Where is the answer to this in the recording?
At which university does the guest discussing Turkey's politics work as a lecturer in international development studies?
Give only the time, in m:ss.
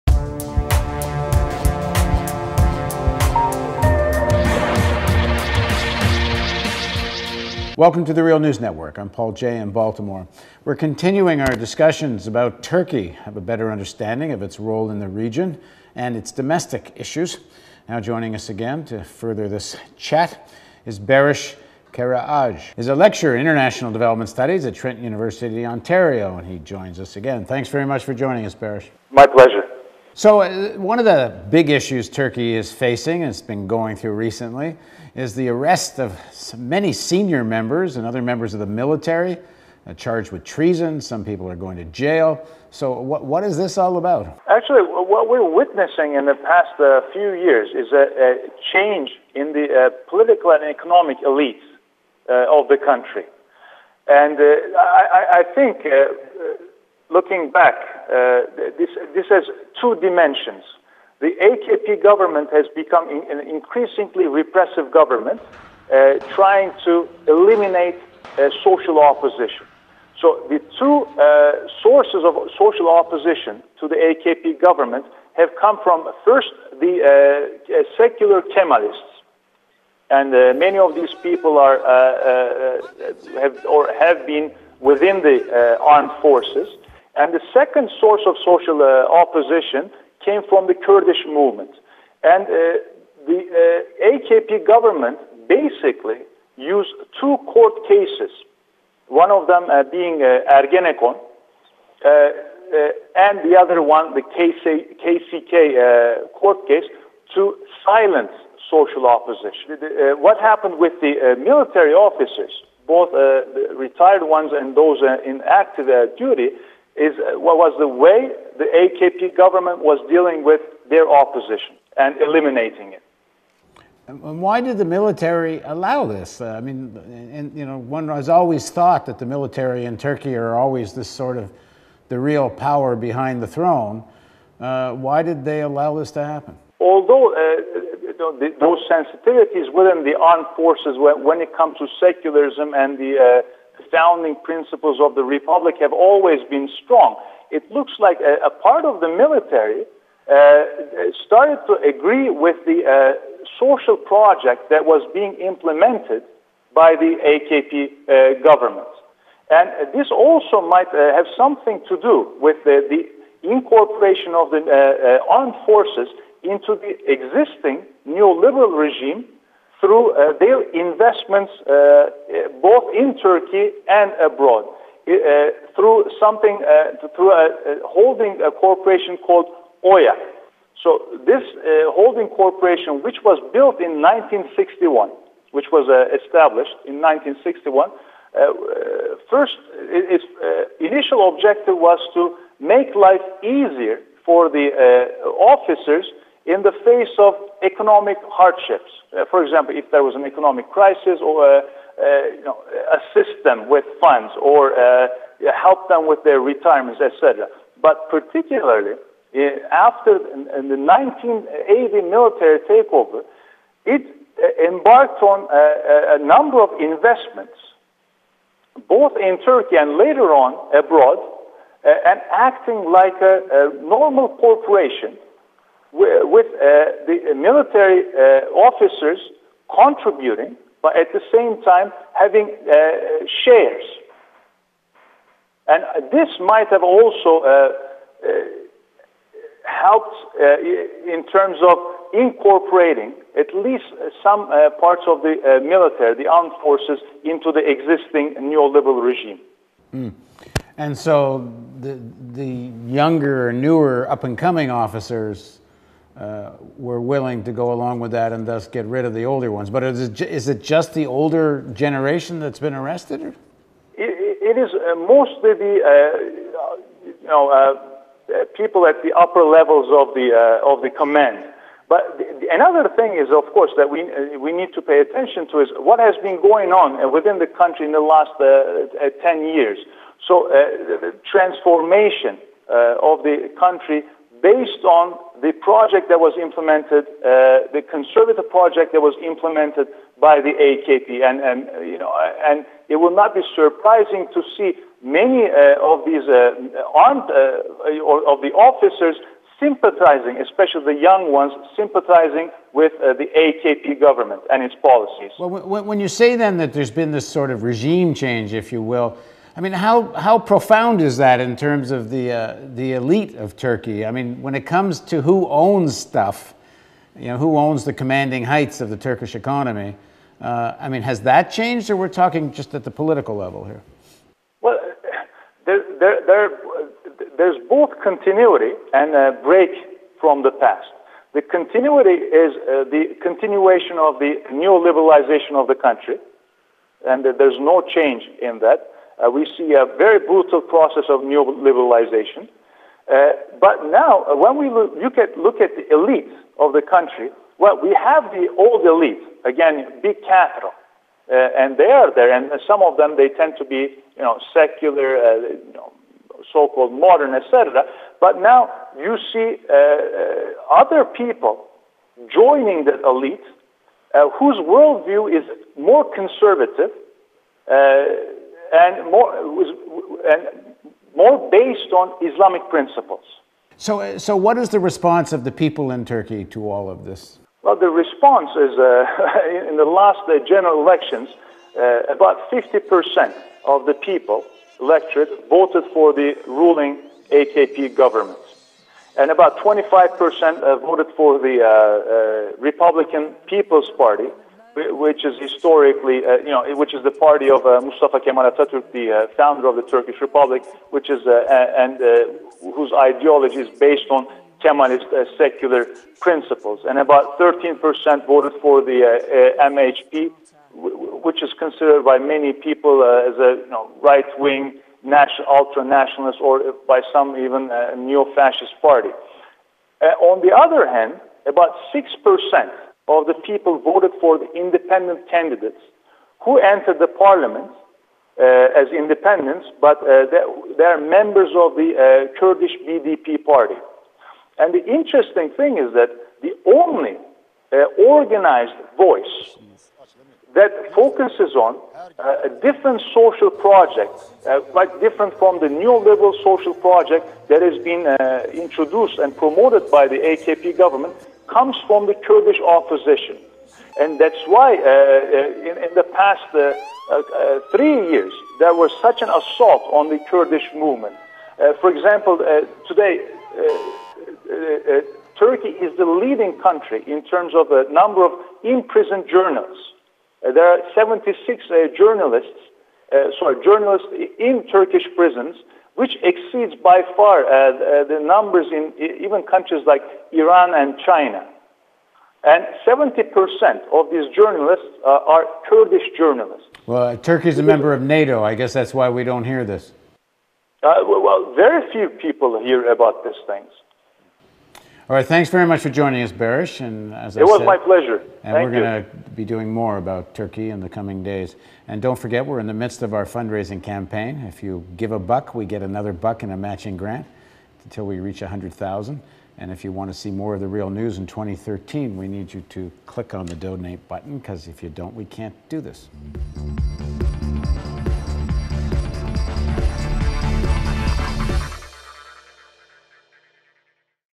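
0:24.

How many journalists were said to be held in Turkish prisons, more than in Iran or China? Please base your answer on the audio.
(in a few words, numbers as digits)
76.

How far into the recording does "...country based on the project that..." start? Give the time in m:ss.
4:43.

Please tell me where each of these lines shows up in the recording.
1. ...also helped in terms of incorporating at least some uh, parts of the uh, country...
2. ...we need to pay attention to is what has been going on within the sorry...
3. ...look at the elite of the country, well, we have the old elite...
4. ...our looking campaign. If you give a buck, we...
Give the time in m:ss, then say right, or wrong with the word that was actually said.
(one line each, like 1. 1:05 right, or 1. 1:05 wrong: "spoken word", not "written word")
1. 3:56 wrong: "military", not "country"
2. 4:34 wrong: "country", not "sorry"
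3. 5:45 right
4. 8:23 wrong: "fundraising", not "looking".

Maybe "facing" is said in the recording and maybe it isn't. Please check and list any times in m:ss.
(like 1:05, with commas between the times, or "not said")
0:32.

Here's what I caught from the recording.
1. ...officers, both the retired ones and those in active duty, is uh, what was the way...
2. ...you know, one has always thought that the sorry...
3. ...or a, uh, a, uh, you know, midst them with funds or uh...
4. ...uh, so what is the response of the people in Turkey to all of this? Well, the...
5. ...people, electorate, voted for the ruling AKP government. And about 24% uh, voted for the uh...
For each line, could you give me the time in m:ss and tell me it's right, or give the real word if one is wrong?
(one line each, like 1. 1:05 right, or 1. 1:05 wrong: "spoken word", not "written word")
1. 1:51 right
2. 2:07 wrong: "military", not "sorry"
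3. 3:21 wrong: "assist", not "midst"
4. 6:13 right
5. 6:23 wrong: "25", not "24".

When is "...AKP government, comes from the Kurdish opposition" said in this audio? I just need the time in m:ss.
7:30.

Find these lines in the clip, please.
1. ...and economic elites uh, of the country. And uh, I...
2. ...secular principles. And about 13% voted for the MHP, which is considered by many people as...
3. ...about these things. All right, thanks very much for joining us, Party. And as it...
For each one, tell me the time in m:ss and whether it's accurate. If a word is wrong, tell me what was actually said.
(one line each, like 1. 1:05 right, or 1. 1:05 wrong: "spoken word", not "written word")
1. 0:50 right
2. 6:45 right
3. 8:12 wrong: "Baris", not "Party".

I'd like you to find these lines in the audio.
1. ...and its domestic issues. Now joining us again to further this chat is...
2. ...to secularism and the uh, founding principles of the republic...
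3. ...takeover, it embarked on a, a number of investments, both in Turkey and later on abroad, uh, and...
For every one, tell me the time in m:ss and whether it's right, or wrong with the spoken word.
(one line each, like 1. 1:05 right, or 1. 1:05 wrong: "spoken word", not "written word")
1. 0:15 right
2. 2:21 right
3. 3:32 right.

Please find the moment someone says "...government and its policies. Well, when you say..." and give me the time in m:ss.
5:03.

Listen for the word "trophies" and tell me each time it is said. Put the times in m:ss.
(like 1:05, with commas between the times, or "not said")
not said.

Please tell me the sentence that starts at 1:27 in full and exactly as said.
And the second source of social uh, opposition came from the Kurdish movement.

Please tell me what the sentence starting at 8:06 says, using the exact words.
Well, uh, Turkey's a member of NATO.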